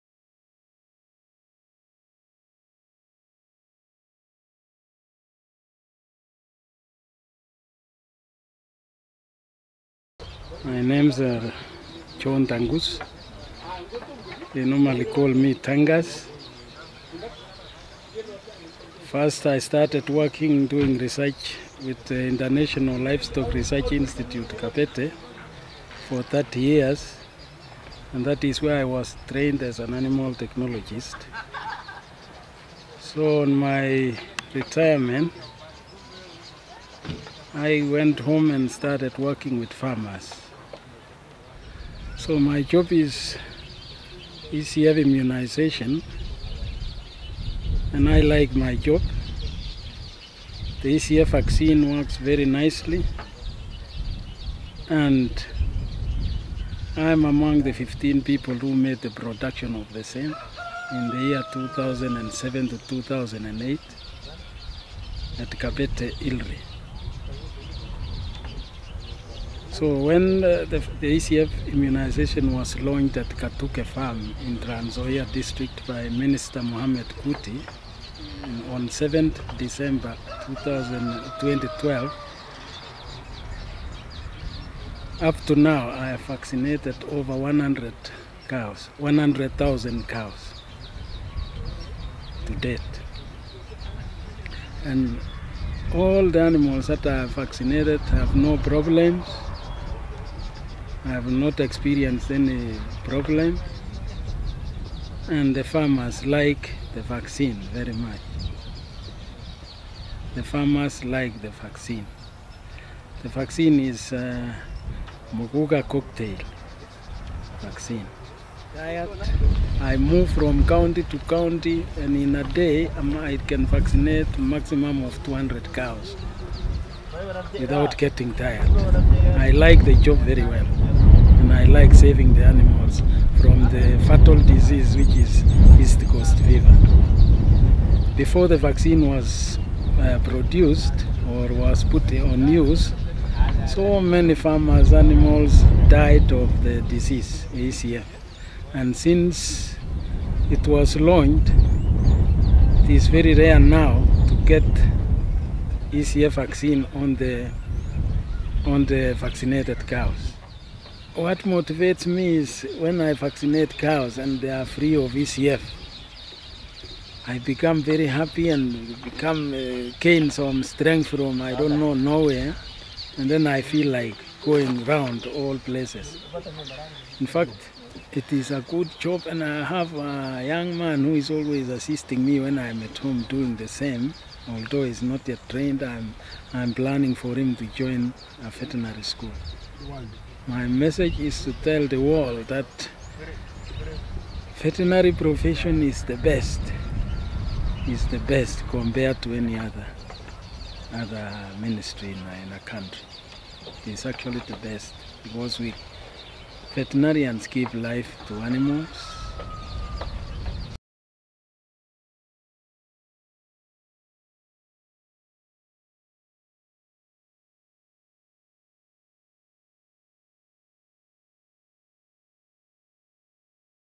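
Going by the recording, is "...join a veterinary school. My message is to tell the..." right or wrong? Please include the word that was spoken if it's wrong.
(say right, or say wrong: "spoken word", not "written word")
right.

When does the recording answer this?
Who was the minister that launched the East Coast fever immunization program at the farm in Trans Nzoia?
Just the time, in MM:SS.
01:16.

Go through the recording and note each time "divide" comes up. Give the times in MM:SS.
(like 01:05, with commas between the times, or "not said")
not said.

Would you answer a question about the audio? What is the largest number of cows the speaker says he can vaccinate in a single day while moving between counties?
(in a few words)
200.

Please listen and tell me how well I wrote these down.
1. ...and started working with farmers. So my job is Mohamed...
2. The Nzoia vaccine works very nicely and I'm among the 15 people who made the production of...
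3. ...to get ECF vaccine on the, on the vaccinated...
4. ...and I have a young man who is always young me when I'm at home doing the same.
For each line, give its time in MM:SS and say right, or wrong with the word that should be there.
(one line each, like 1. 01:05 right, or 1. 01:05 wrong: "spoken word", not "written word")
1. 00:38 wrong: "ECF", not "Mohamed"
2. 00:50 wrong: "ECF", not "Nzoia"
3. 02:34 right
4. 02:59 wrong: "assisting", not "young".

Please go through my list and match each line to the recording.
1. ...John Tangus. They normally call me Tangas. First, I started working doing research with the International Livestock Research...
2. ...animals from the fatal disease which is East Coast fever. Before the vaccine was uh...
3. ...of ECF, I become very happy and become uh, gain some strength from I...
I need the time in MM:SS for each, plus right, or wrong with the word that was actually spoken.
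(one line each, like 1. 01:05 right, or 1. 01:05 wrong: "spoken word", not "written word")
1. 00:12 right
2. 02:12 right
3. 02:44 right.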